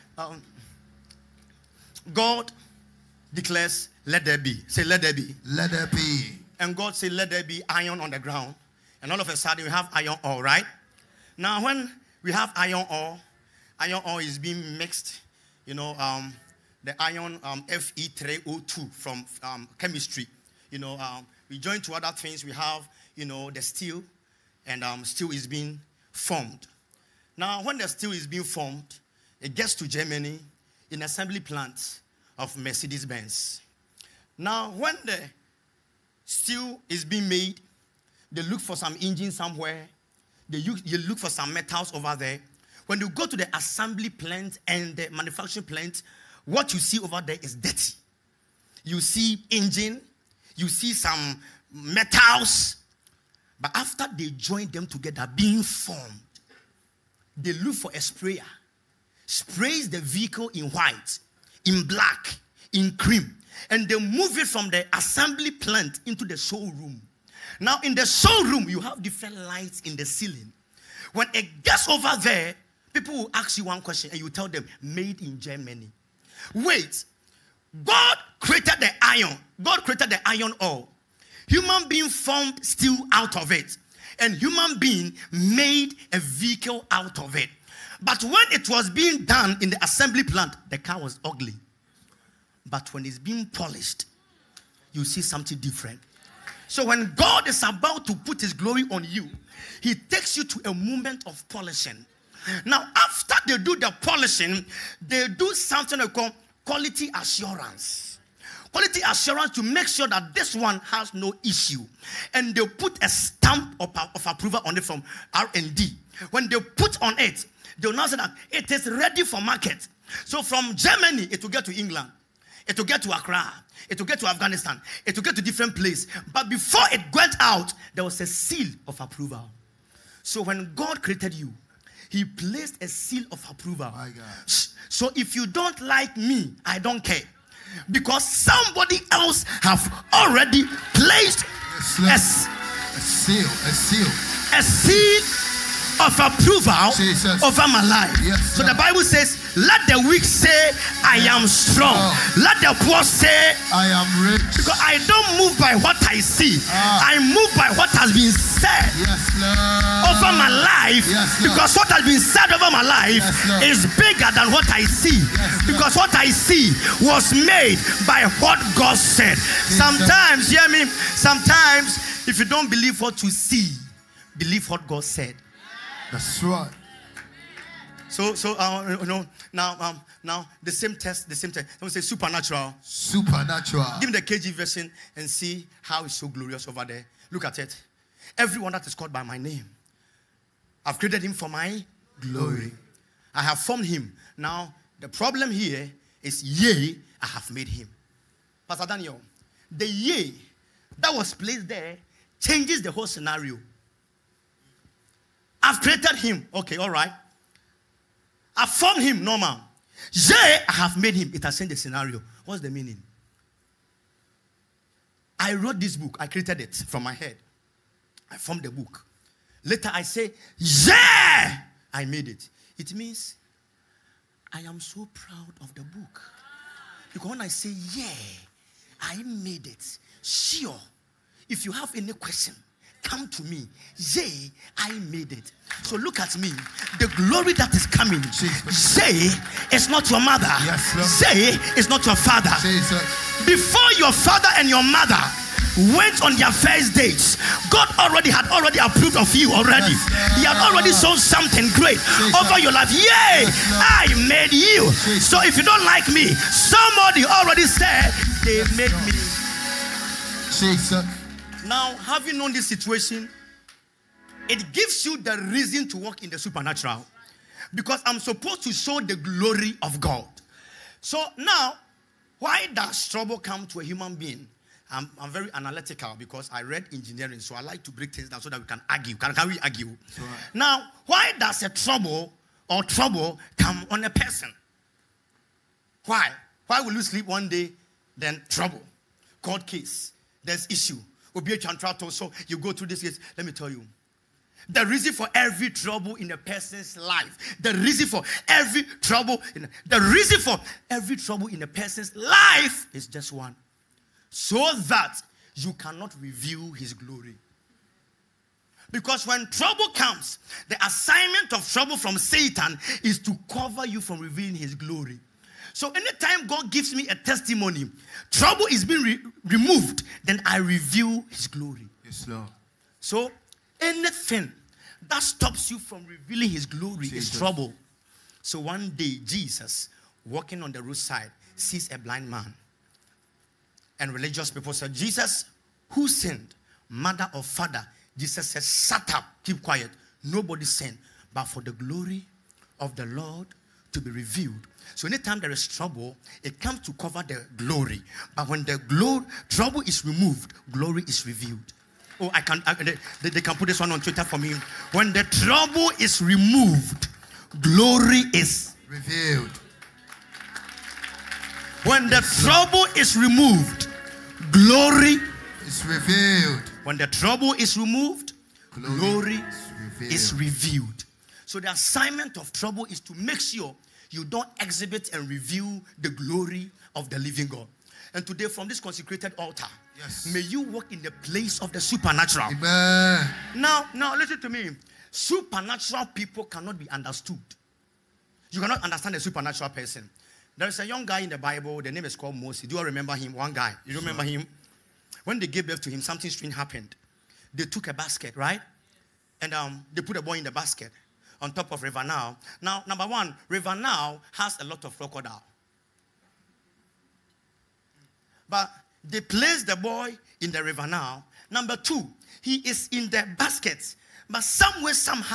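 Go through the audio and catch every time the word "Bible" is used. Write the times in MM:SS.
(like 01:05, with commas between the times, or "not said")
02:28, 06:31.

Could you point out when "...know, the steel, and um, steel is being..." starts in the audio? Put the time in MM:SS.
00:23.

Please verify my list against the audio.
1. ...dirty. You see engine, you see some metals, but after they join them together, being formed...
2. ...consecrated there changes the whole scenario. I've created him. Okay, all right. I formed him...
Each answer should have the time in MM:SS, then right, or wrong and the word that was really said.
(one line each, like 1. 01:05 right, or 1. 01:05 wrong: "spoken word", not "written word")
1. 00:47 right
2. 03:21 wrong: "placed", not "consecrated".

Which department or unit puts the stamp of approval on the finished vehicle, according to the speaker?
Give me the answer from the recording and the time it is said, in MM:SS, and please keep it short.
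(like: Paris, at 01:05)
R&D, at 01:55.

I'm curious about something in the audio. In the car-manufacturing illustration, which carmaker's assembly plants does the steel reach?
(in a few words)
Mercedes Benz.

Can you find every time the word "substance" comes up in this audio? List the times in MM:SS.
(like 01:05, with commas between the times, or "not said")
not said.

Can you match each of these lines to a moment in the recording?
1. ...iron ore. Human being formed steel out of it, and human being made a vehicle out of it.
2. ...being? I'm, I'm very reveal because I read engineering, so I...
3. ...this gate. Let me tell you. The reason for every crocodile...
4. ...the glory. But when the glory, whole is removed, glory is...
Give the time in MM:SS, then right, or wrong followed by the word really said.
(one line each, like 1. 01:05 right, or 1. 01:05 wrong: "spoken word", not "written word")
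1. 01:20 right
2. 04:34 wrong: "analytical", not "reveal"
3. 04:52 wrong: "trouble", not "crocodile"
4. 05:47 wrong: "trouble", not "whole".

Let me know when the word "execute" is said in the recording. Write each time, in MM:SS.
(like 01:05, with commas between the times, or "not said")
not said.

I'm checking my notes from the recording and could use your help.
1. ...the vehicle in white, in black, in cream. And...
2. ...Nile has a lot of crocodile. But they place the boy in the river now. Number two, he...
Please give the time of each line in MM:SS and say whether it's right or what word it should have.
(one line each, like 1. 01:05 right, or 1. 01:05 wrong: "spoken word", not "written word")
1. 00:59 right
2. 06:43 right.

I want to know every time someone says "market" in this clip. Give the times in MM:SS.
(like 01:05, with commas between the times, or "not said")
01:59.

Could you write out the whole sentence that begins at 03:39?
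Later I say, yeah, I made it.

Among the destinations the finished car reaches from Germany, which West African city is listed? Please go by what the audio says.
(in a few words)
Accra.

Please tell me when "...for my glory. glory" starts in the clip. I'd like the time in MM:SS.
03:11.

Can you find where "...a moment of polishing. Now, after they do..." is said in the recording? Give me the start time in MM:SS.
01:40.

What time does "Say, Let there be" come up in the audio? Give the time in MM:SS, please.
00:04.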